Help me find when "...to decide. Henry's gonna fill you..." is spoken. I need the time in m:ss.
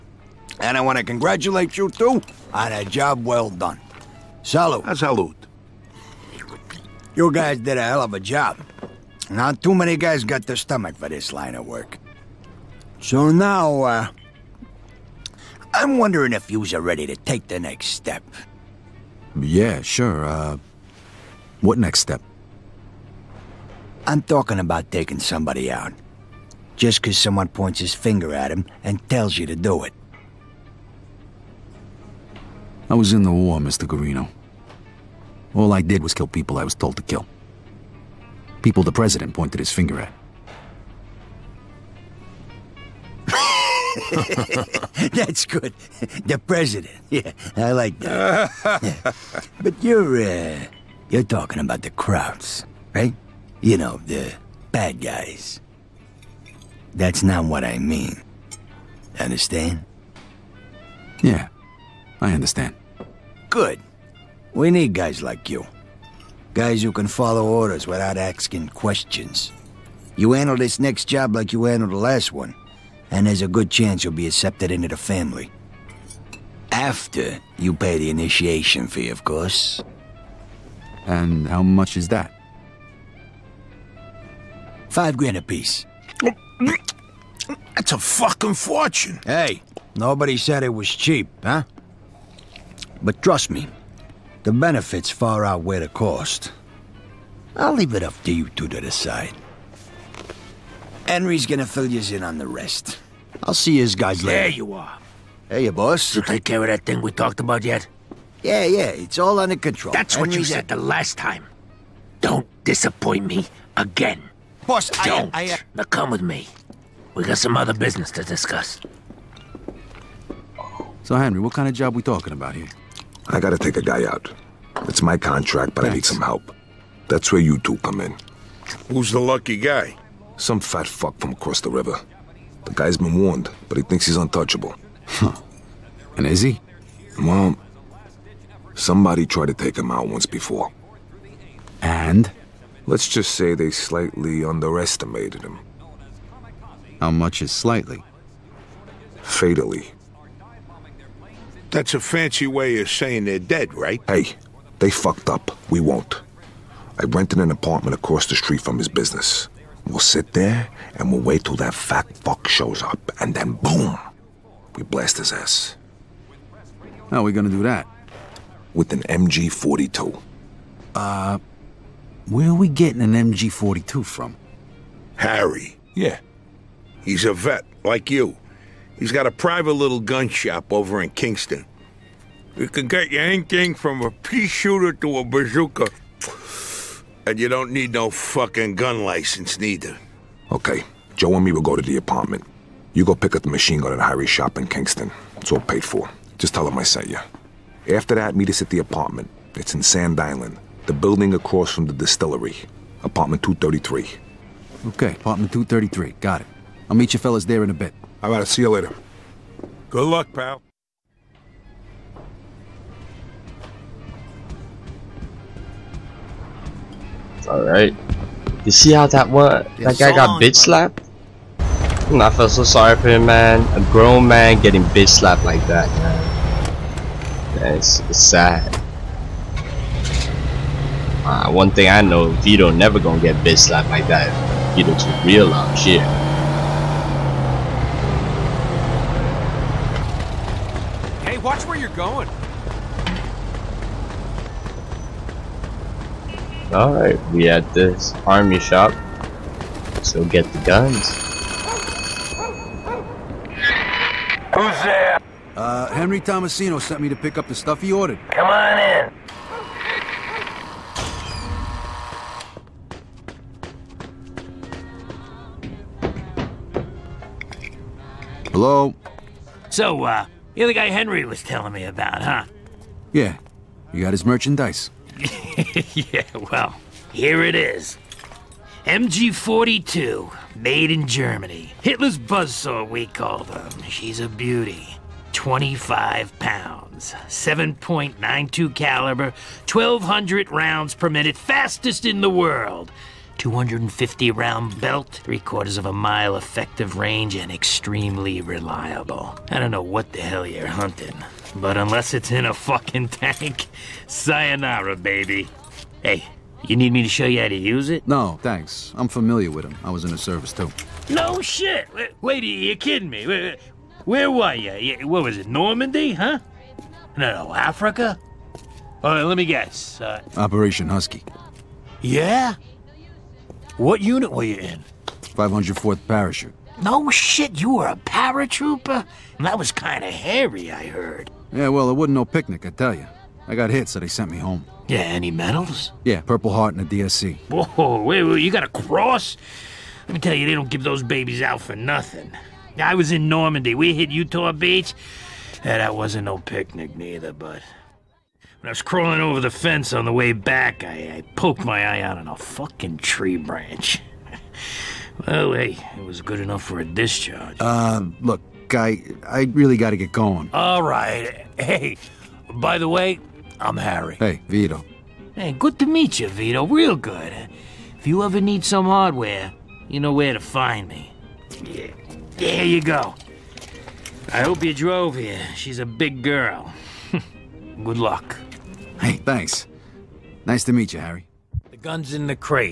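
1:38.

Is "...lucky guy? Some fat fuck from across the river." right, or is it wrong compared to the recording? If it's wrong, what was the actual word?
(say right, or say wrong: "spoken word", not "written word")
right.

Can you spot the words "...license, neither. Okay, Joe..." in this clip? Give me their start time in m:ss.
3:09.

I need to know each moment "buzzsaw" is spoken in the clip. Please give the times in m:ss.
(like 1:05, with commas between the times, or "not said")
4:42.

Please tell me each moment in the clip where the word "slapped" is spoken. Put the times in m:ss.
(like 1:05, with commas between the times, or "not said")
3:40, 3:45, 3:53.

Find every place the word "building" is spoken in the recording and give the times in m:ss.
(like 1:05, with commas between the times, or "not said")
3:20.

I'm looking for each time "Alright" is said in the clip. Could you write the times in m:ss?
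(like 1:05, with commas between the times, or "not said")
3:37, 4:06.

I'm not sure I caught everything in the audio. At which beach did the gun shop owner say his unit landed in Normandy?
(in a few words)
Utah Beach.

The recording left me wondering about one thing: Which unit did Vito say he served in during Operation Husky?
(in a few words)
504th Parachute.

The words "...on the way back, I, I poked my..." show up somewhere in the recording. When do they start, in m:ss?
5:49.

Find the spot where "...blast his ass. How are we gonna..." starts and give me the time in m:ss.
2:44.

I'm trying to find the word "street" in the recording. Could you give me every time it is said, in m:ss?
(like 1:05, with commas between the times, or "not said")
2:38.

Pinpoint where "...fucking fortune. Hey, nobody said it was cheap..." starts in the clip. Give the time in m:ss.
1:27.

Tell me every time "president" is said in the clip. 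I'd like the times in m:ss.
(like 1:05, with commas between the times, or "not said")
0:38, 0:46.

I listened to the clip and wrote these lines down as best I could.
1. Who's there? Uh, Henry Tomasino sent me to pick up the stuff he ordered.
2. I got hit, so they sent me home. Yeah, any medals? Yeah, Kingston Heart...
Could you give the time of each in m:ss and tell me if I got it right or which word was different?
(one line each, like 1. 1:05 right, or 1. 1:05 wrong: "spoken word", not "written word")
1. 4:14 right
2. 5:33 wrong: "Purple", not "Kingston".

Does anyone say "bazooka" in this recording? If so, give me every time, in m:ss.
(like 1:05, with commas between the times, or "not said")
3:05.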